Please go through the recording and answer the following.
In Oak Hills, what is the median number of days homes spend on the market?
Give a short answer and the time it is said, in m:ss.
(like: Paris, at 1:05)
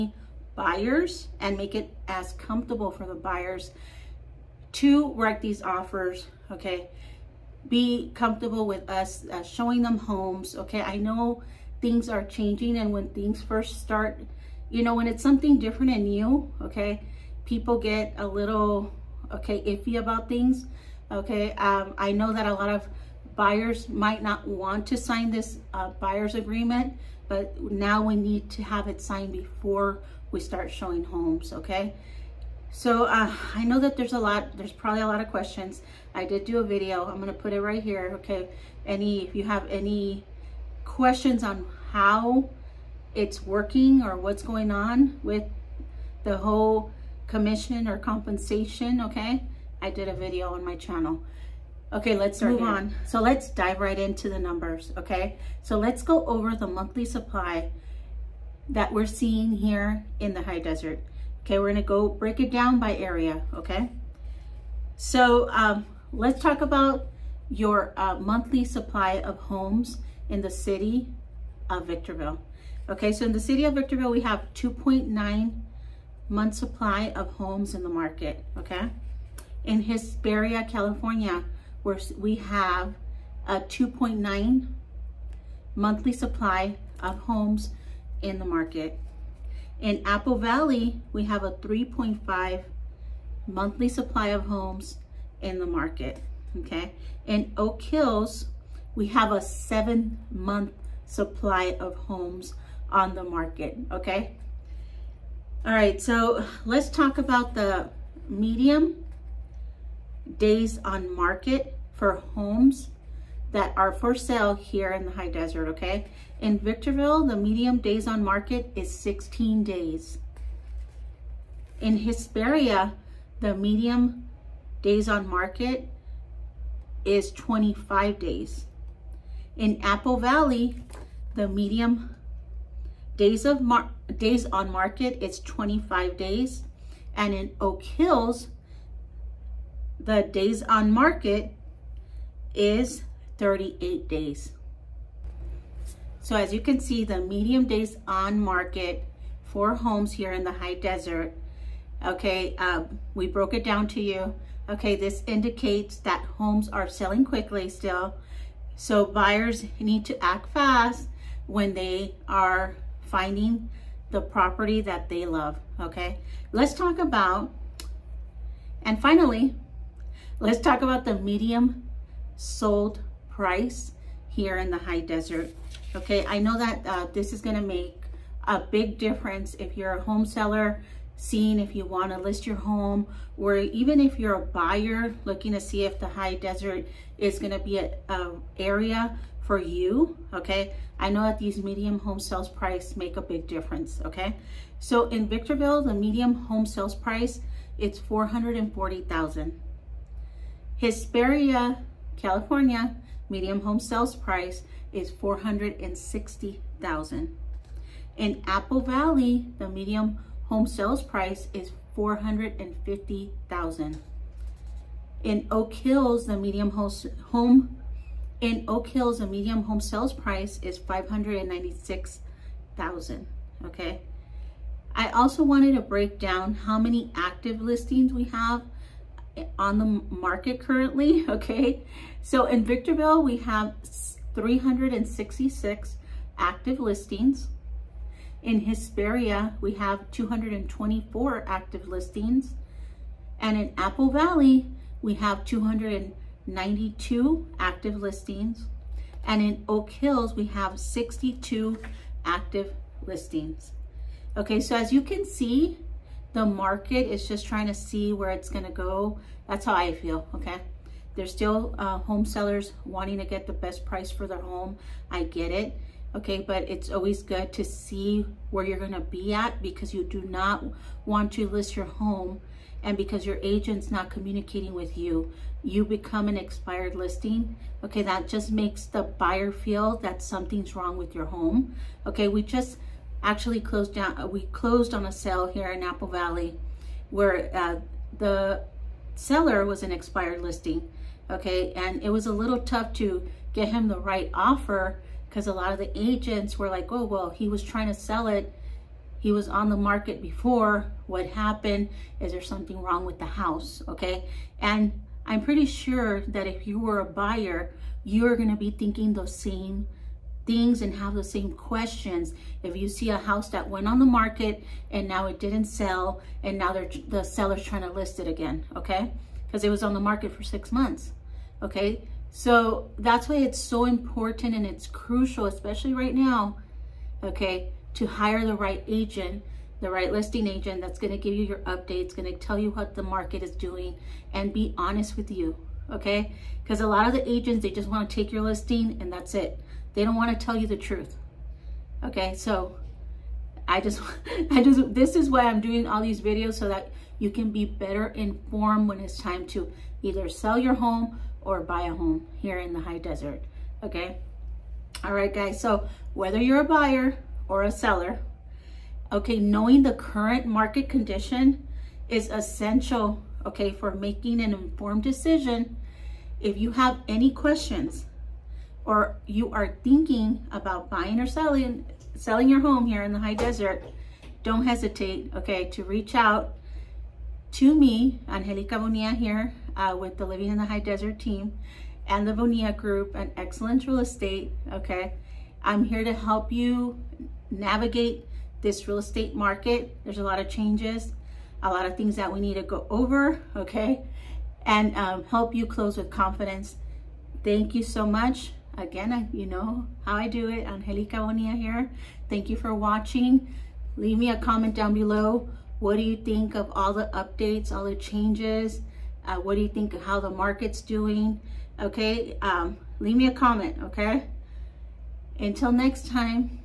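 38 days, at 2:23.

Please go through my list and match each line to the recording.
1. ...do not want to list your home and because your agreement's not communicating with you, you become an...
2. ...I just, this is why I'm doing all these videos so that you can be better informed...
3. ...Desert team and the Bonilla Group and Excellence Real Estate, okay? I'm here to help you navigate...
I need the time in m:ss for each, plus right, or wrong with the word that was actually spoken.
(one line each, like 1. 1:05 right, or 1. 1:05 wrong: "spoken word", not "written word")
1. 4:30 wrong: "agent", not "agreement"
2. 5:44 right
3. 6:20 right.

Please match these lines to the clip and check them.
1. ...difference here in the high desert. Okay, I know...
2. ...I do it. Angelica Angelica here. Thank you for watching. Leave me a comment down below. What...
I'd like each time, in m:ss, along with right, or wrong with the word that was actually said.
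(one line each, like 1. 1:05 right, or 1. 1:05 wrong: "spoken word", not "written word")
1. 2:53 wrong: "price", not "difference"
2. 6:40 wrong: "Bonilla", not "Angelica".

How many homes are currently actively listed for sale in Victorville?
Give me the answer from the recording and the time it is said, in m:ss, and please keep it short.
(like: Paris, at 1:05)
366, at 3:54.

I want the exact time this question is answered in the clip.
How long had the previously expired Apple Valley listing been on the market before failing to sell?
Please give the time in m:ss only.
5:20.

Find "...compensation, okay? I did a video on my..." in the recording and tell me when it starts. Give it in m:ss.
0:47.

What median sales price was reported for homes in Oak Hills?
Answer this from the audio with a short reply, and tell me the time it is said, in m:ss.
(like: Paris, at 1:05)
$596,000, at 3:40.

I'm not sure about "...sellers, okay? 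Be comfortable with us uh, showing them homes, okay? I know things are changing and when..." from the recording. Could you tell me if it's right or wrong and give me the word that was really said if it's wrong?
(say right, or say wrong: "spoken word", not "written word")
wrong: "offers", not "sellers".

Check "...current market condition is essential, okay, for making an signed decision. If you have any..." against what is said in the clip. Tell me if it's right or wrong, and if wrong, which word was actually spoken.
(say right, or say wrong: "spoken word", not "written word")
wrong: "informed", not "signed".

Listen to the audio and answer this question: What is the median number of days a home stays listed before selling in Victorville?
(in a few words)
16 days.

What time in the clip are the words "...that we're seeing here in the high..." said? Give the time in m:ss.
0:58.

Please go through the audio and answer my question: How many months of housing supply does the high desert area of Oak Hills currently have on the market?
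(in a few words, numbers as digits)
7 months.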